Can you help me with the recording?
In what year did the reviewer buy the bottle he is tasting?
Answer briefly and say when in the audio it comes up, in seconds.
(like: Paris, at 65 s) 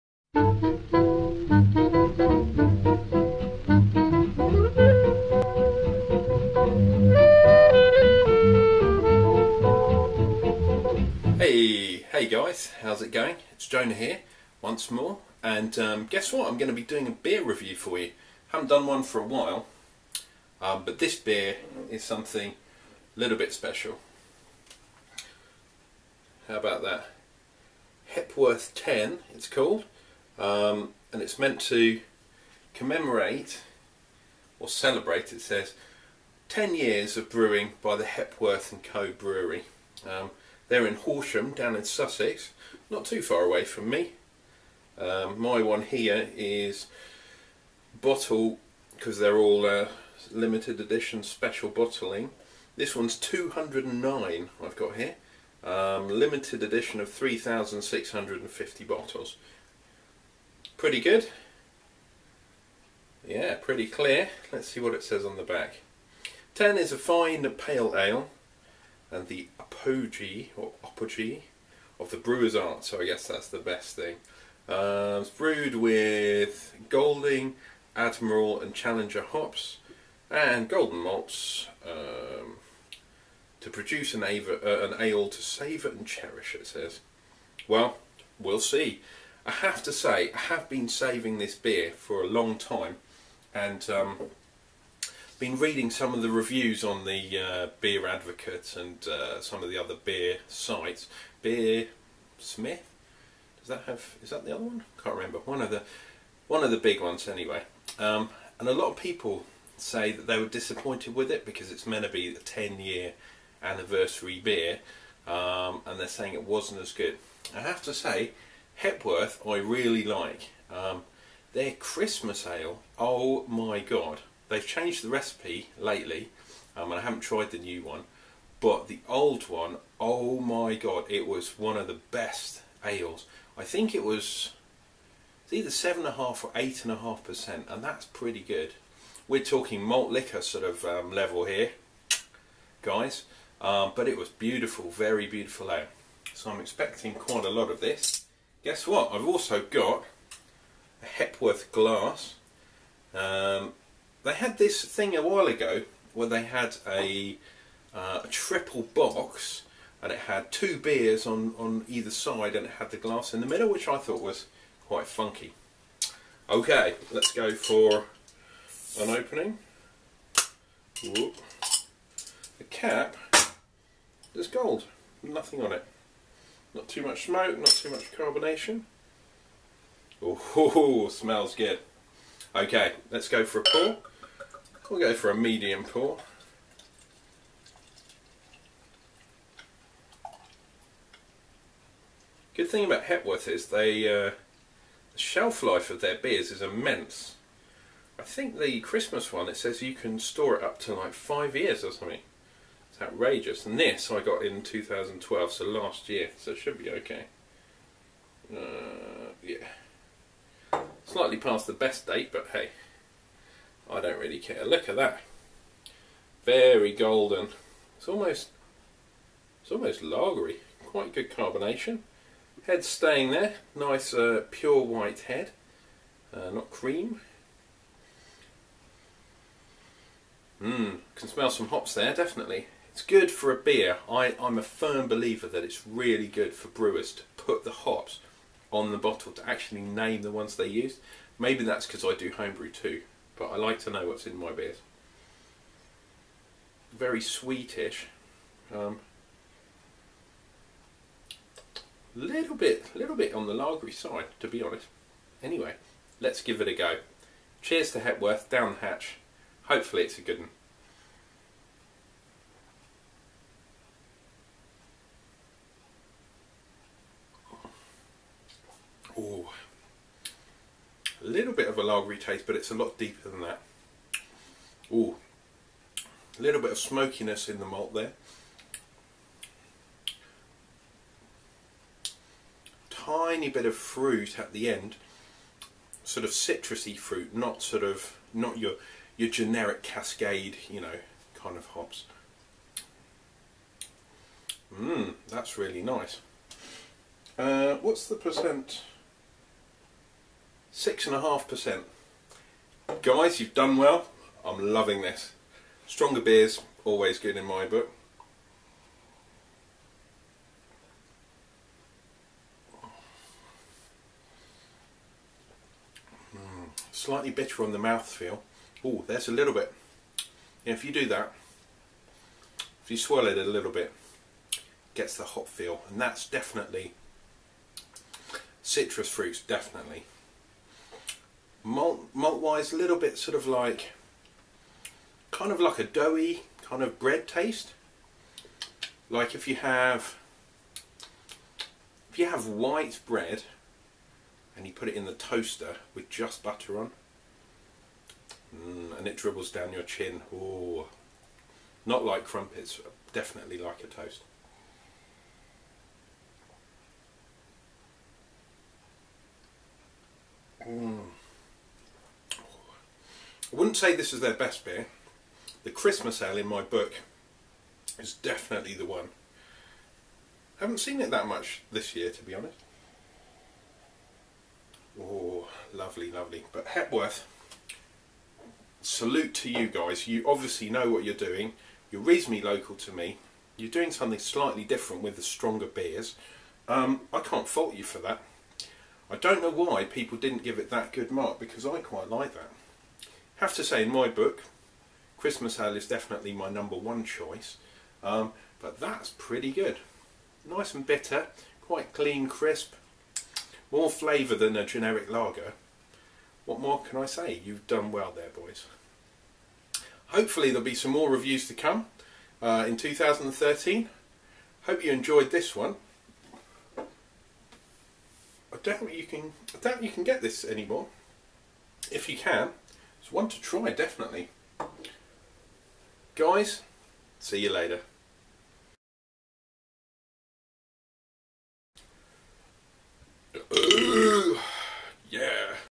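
2012, at 204 s.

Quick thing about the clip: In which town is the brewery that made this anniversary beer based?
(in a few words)
Horsham.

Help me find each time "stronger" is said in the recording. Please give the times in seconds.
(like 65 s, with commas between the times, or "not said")
305 s, 385 s.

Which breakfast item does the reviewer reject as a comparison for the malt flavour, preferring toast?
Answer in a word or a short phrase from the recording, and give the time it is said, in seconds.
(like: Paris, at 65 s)
crumpets, at 352 s.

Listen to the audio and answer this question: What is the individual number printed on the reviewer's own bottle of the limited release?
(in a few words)
209.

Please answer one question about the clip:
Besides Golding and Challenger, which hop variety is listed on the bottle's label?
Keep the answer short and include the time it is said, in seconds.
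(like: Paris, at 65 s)
Admiral, at 77 s.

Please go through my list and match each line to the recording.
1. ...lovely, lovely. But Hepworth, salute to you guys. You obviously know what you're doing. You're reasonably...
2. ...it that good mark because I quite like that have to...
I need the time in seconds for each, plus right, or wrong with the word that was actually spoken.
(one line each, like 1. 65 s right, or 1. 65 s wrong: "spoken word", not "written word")
1. 375 s right
2. 390 s right.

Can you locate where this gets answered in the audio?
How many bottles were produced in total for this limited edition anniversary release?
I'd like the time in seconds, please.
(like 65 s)
57 s.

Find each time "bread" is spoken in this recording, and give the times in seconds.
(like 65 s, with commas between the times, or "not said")
336 s, 343 s.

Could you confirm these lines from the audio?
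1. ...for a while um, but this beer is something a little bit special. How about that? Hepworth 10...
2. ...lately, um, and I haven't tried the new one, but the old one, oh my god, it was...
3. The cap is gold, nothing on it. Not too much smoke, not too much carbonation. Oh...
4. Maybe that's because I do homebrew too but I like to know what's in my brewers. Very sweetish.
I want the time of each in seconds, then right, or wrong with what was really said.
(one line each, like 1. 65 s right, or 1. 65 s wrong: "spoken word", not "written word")
1. 19 s right
2. 125 s right
3. 172 s right
4. 241 s wrong: "beers", not "brewers".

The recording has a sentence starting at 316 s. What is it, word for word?
Mm, slightly bitter on the mouth feel.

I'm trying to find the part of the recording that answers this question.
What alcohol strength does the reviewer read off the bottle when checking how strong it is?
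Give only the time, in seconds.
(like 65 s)
300 s.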